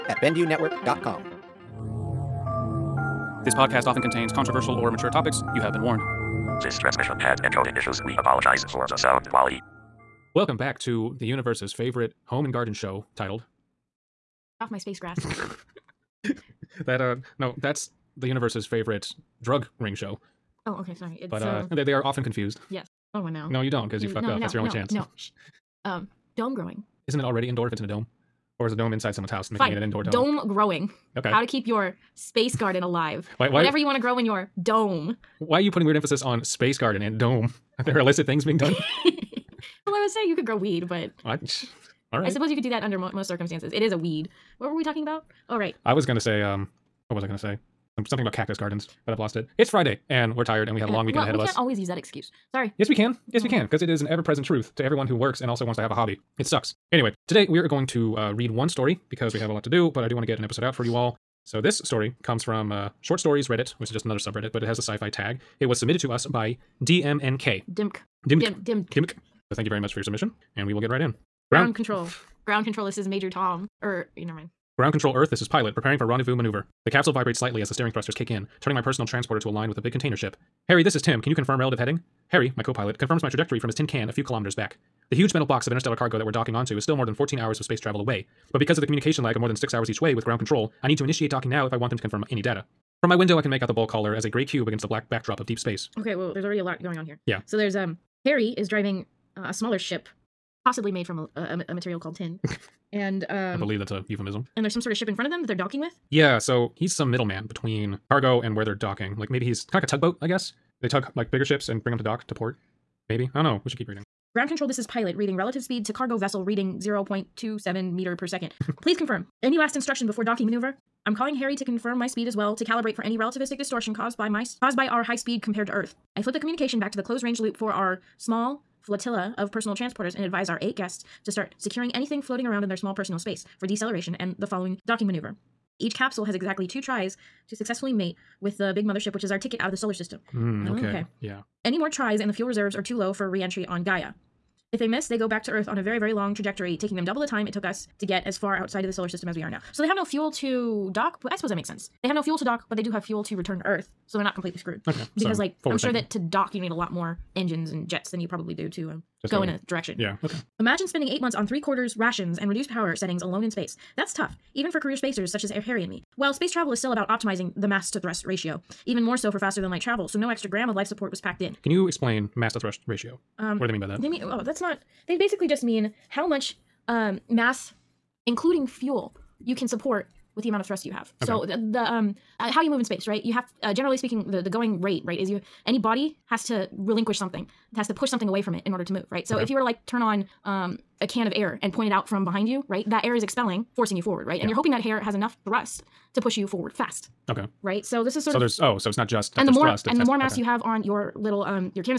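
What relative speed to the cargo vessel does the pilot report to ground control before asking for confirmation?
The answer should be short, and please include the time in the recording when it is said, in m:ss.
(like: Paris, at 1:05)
0.27 meters per second, at 1:56.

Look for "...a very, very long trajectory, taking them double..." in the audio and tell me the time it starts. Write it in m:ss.
2:25.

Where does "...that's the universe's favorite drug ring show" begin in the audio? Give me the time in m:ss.
0:17.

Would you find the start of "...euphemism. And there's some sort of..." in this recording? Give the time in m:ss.
1:44.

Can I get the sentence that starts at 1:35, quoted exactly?
Okay, well, there's already a lot going on here.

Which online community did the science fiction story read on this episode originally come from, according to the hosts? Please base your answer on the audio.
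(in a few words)
Short Stories Reddit.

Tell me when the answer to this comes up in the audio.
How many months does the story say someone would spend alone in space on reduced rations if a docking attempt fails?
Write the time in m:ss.
2:41.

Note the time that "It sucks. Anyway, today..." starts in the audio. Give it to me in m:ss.
0:56.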